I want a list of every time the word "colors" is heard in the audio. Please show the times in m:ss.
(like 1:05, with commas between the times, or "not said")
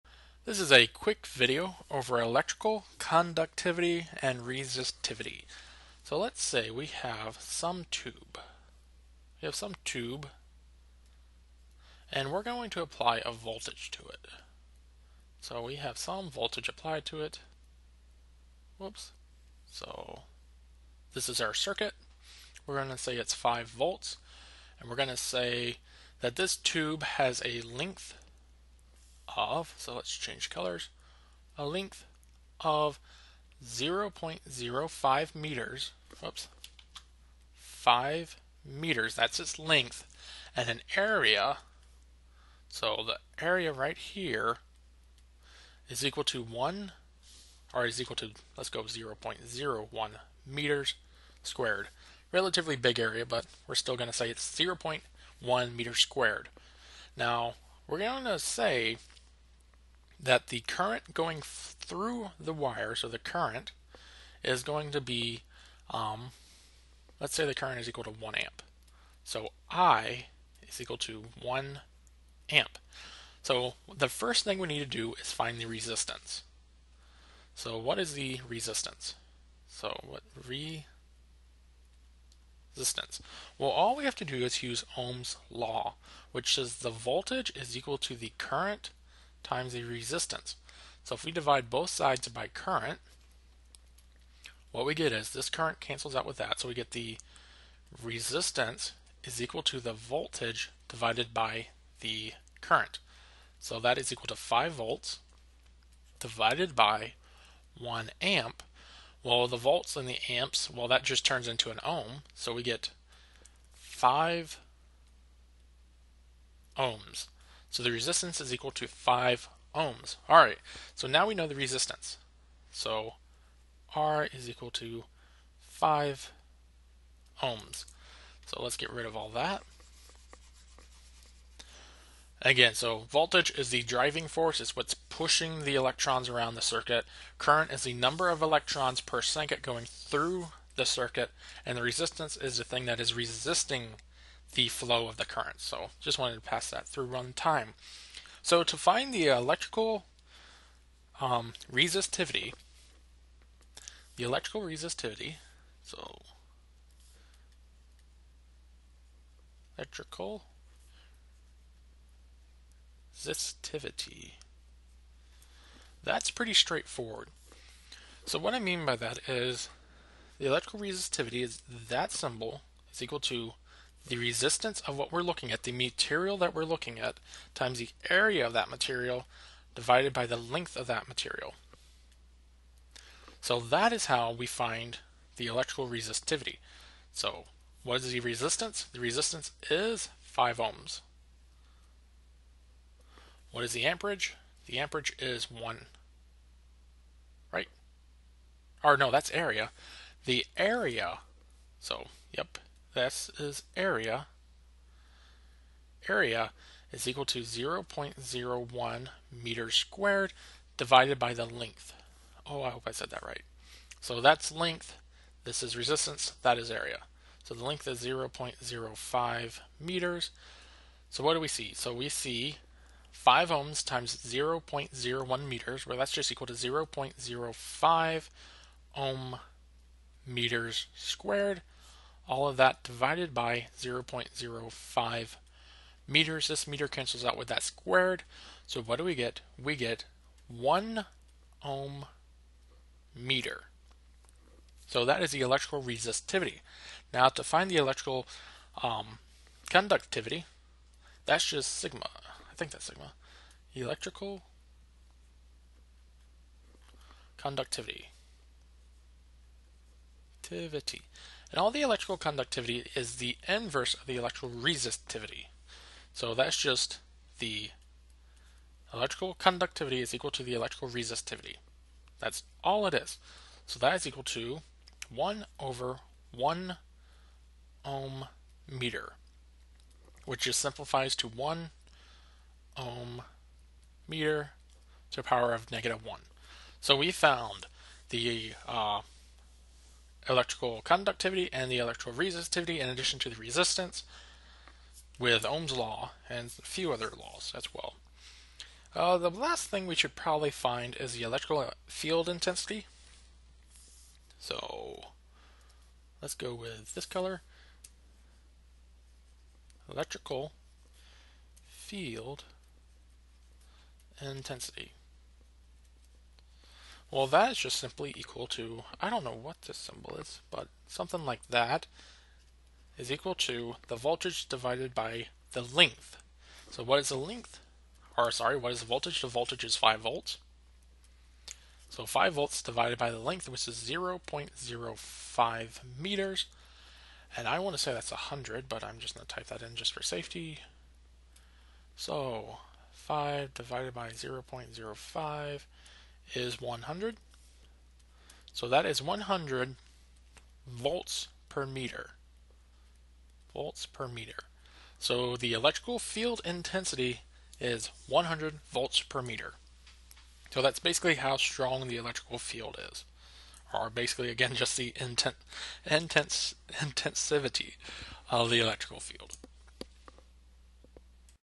0:30, 5:07.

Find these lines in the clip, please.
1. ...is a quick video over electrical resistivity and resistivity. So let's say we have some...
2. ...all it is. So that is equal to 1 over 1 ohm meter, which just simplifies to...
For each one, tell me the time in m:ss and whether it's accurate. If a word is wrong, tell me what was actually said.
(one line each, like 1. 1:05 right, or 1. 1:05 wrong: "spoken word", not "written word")
1. 0:00 wrong: "conductivity", not "resistivity"
2. 4:32 right.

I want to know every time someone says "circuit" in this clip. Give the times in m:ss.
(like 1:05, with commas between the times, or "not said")
0:21, 2:16, 2:20.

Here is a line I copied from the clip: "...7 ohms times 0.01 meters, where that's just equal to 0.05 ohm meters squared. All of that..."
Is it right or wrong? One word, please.
wrong.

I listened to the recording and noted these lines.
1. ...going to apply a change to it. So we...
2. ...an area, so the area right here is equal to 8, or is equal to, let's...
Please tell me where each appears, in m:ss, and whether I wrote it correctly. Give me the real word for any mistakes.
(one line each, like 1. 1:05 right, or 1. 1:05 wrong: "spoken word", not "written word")
1. 0:12 wrong: "voltage", not "change"
2. 0:40 wrong: "1", not "8".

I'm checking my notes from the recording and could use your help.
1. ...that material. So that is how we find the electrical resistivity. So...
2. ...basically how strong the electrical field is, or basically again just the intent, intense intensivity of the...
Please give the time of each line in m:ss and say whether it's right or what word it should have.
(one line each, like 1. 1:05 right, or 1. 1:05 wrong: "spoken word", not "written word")
1. 3:00 right
2. 6:00 right.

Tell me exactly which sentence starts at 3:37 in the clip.
So the length is 0.05 meters.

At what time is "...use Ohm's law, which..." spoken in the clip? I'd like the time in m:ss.
1:24.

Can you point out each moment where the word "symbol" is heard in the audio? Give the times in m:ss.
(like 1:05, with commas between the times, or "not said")
2:52, 5:19.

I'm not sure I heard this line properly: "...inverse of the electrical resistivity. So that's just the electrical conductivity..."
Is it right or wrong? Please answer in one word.
right.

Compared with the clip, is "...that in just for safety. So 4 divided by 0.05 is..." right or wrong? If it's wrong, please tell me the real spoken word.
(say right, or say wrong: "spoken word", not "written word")
wrong: "5", not "4".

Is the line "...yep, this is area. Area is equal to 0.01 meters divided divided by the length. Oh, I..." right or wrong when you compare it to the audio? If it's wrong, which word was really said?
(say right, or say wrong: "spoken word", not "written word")
wrong: "squared", not "divided".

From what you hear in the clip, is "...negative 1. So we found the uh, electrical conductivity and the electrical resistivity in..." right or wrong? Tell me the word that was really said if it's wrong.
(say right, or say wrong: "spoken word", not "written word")
right.